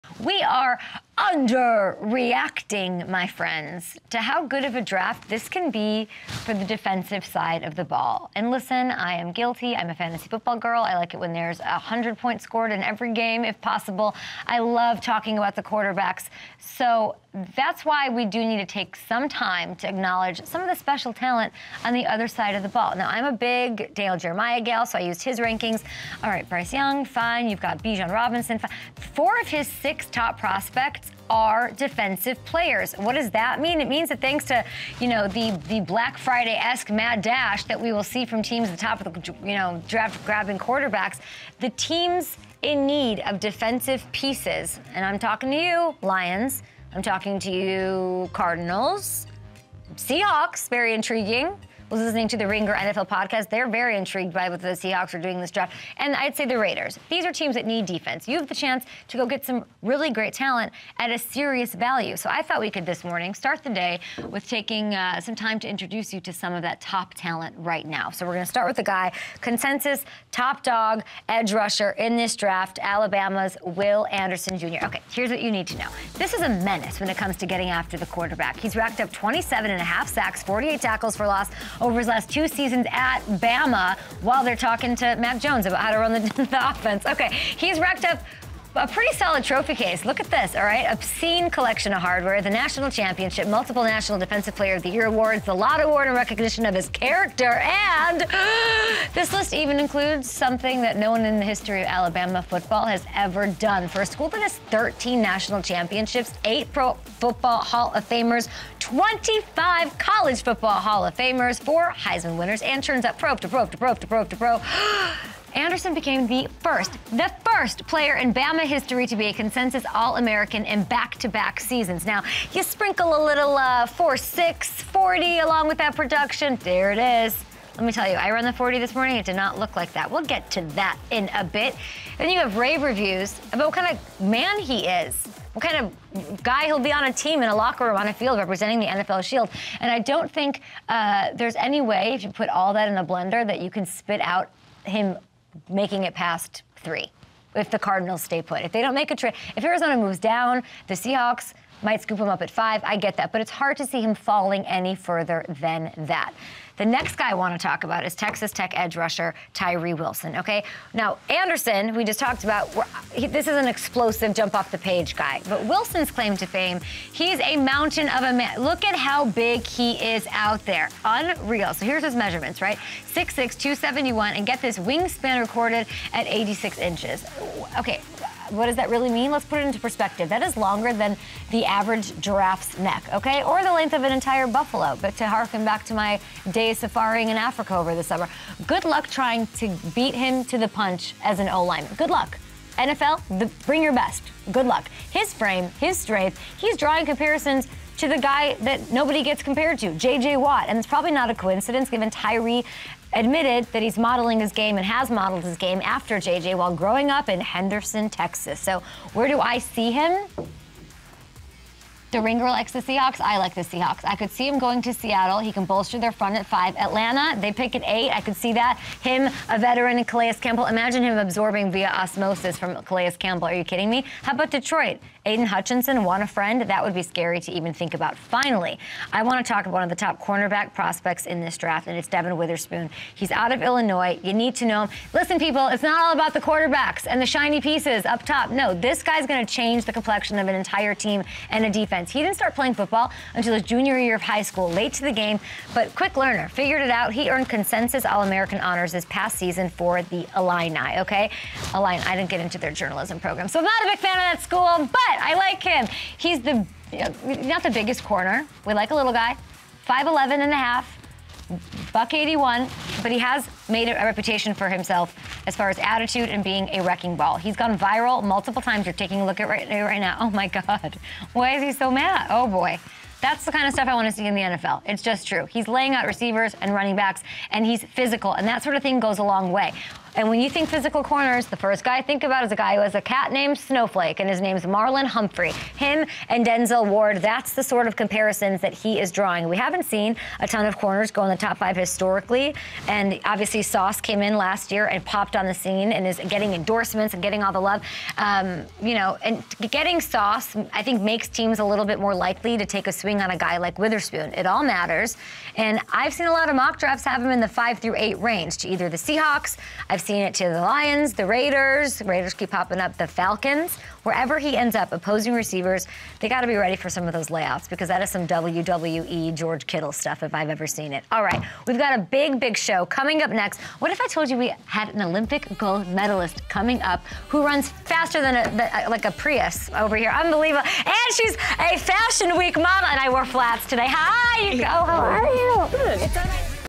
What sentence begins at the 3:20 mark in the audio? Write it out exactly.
And it's probably not a coincidence given Tyree admitted that he's modeling his game and has modeled his game after J.J.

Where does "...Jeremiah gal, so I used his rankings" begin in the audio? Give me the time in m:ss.
0:24.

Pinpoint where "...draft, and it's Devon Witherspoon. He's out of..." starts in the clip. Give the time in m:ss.
3:51.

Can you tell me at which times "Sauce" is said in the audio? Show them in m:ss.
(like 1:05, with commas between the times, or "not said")
4:53, 5:00.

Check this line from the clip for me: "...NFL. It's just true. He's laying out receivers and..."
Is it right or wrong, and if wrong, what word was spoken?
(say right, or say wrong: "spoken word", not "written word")
right.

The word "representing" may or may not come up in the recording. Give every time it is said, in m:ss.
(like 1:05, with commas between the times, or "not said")
2:18.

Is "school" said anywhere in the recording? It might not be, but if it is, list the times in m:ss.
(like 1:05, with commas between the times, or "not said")
1:44, 4:04, 4:14.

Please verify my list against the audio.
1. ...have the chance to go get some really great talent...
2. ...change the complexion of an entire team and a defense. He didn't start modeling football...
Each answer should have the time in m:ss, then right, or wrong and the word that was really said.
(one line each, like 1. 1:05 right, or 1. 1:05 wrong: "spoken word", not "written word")
1. 0:58 right
2. 3:59 wrong: "playing", not "modeling".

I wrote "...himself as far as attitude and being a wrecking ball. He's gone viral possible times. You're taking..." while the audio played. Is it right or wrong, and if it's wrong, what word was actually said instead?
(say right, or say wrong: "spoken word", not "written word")
wrong: "multiple", not "possible".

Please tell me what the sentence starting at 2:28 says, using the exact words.
If they don't make a trade, if Arizona moves down, the Seahawks might scoop him up at five.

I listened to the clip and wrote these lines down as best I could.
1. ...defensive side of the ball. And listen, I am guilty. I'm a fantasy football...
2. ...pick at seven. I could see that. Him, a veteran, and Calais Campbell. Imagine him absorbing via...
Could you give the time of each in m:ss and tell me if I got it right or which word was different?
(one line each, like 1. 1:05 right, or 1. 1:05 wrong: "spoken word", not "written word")
1. 0:06 right
2. 3:37 wrong: "eight", not "seven".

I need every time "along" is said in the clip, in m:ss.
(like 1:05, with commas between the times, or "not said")
2:05.